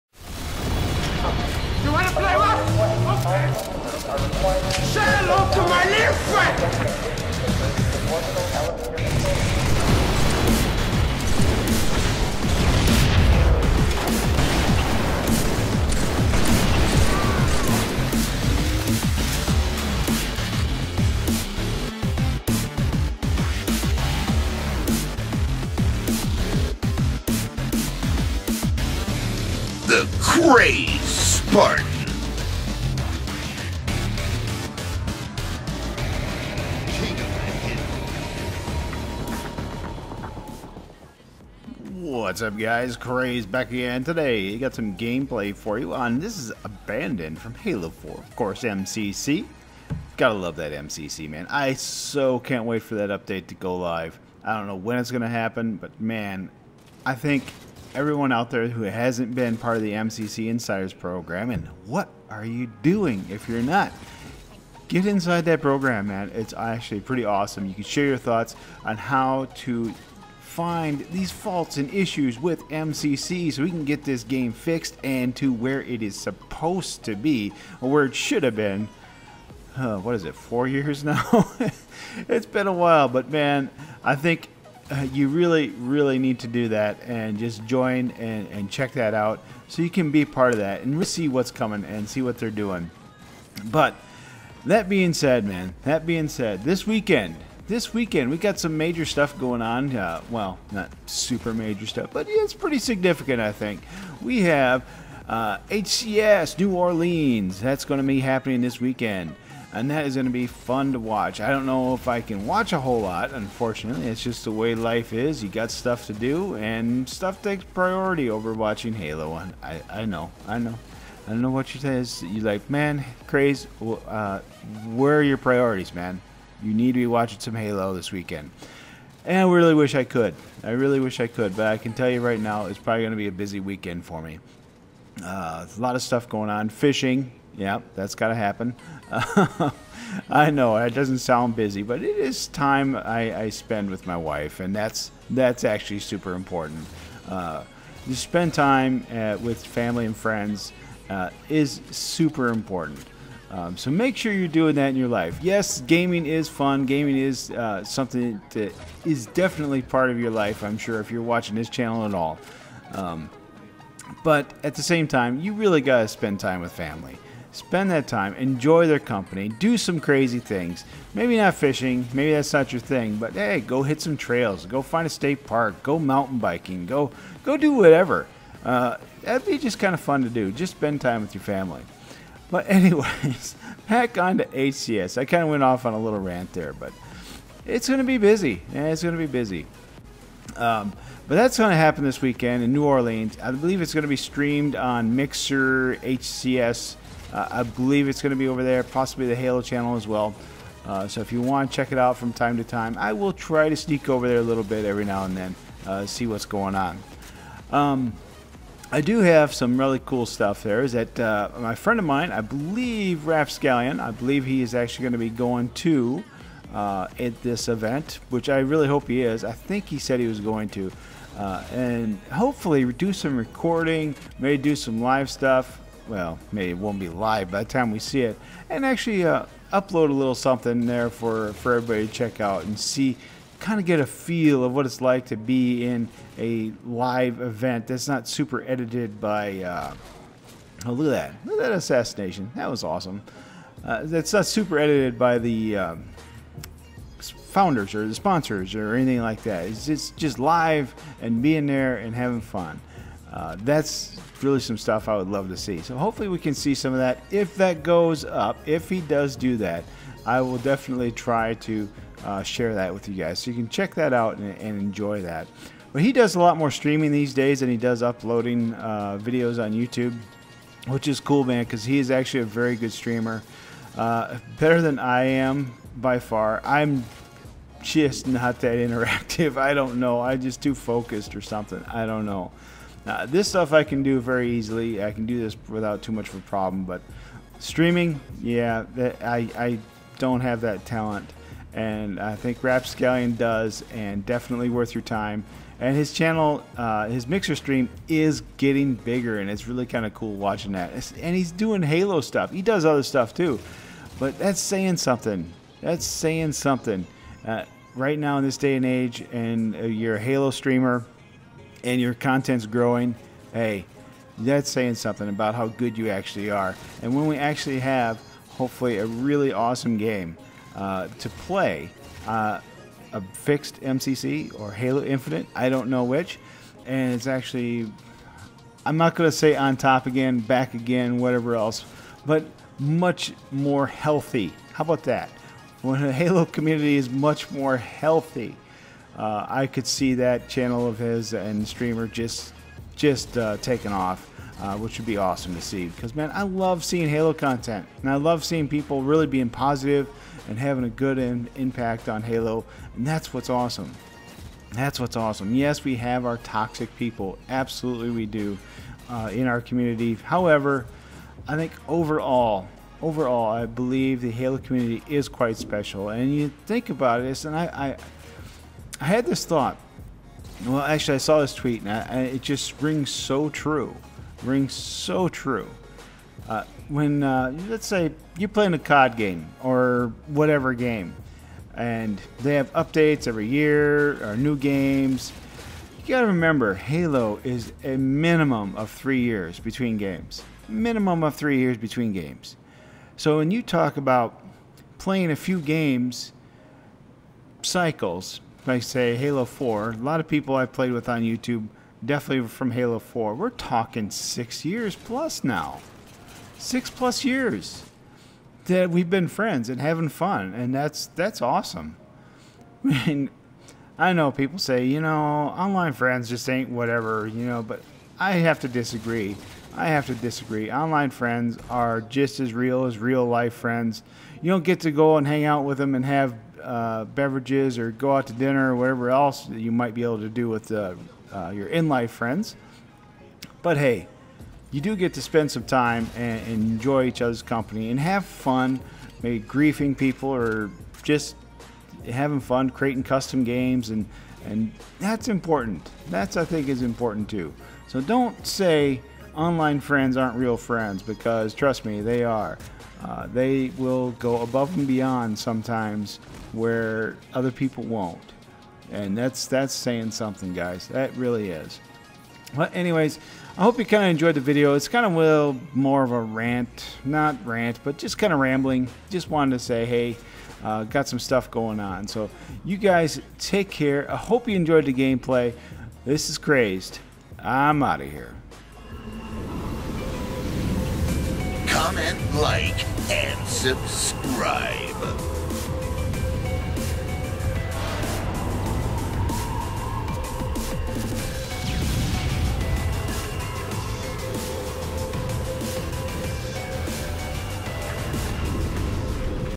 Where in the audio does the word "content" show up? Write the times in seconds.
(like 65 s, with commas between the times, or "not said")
312 s, 347 s.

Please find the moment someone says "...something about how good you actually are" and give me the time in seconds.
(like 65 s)
314 s.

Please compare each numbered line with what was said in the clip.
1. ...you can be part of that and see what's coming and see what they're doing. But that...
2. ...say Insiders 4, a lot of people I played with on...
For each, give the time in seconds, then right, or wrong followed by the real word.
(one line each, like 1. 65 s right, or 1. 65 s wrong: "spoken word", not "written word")
1. 89 s right
2. 398 s wrong: "Halo", not "Insiders".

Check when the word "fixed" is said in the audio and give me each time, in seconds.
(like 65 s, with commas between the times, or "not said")
74 s, 323 s.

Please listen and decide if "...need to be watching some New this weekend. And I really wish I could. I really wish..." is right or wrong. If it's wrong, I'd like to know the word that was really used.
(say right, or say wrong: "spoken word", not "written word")
wrong: "Halo", not "New".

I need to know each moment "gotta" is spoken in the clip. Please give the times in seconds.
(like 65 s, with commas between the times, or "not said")
50 s, 386 s.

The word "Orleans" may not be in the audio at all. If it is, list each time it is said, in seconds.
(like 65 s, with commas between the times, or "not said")
106 s, 192 s.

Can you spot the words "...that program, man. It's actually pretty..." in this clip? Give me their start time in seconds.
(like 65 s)
65 s.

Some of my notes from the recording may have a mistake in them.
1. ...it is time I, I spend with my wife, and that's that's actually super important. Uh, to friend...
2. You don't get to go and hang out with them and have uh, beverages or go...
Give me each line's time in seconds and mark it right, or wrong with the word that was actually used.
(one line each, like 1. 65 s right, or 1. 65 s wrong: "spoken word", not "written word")
1. 142 s wrong: "spend", not "friend"
2. 424 s right.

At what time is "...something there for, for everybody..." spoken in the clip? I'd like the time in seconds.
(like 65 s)
230 s.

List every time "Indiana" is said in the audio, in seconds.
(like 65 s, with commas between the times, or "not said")
not said.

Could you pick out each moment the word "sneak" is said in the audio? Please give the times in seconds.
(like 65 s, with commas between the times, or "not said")
203 s.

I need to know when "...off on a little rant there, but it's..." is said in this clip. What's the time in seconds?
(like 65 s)
185 s.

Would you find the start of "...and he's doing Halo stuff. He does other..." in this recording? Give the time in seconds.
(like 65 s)
301 s.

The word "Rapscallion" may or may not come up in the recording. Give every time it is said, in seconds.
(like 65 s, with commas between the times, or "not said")
213 s, 292 s.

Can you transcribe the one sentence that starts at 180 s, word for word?
Just spend time with your family.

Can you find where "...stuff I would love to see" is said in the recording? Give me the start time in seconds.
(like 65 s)
254 s.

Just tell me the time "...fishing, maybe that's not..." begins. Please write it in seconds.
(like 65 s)
171 s.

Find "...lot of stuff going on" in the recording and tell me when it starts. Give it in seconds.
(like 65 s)
135 s.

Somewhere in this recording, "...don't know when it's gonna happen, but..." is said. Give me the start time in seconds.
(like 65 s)
54 s.